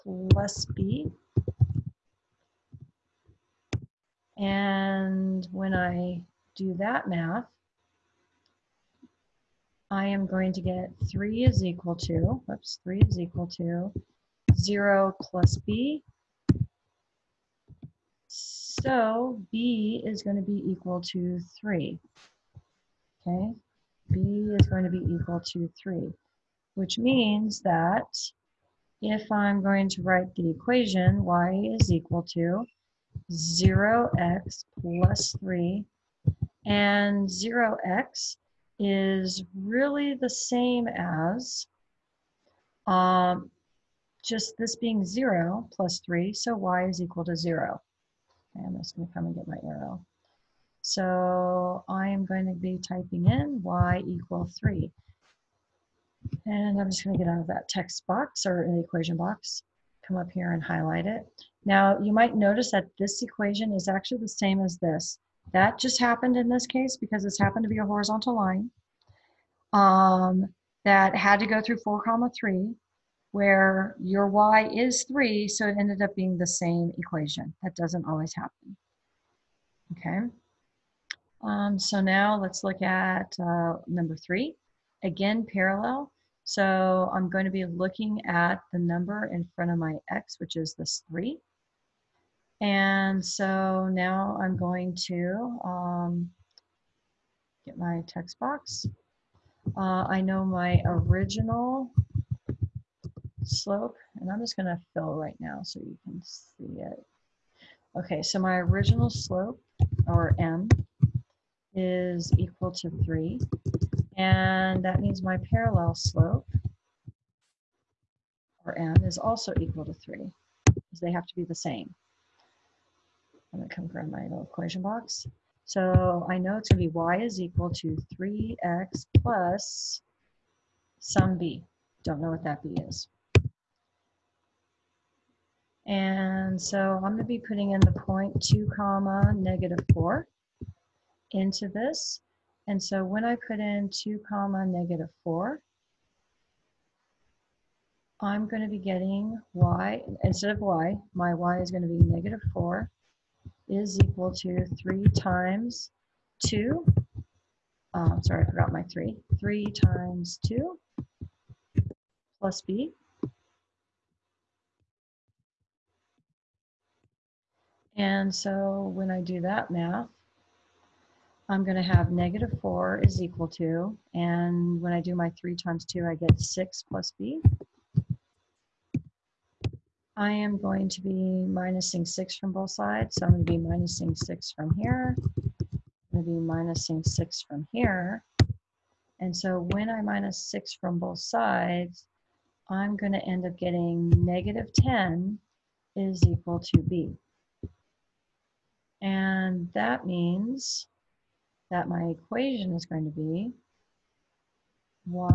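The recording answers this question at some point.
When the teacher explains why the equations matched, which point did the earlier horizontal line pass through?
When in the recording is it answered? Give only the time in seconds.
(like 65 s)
71 s.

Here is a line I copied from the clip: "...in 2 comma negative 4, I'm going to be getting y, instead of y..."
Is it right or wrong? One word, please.
right.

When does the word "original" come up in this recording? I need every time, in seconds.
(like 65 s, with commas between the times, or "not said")
100 s, 108 s.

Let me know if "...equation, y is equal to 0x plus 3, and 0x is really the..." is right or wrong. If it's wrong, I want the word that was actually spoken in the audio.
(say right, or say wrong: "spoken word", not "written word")
right.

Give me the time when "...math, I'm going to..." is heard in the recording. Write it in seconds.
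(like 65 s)
169 s.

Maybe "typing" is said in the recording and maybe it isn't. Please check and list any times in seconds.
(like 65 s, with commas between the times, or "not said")
52 s.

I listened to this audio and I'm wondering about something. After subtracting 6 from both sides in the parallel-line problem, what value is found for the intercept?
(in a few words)
-10.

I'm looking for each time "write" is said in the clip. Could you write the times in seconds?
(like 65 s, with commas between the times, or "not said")
30 s.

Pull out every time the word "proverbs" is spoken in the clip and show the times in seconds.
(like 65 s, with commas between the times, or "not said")
not said.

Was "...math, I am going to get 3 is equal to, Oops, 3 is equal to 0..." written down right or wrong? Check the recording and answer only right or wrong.
right.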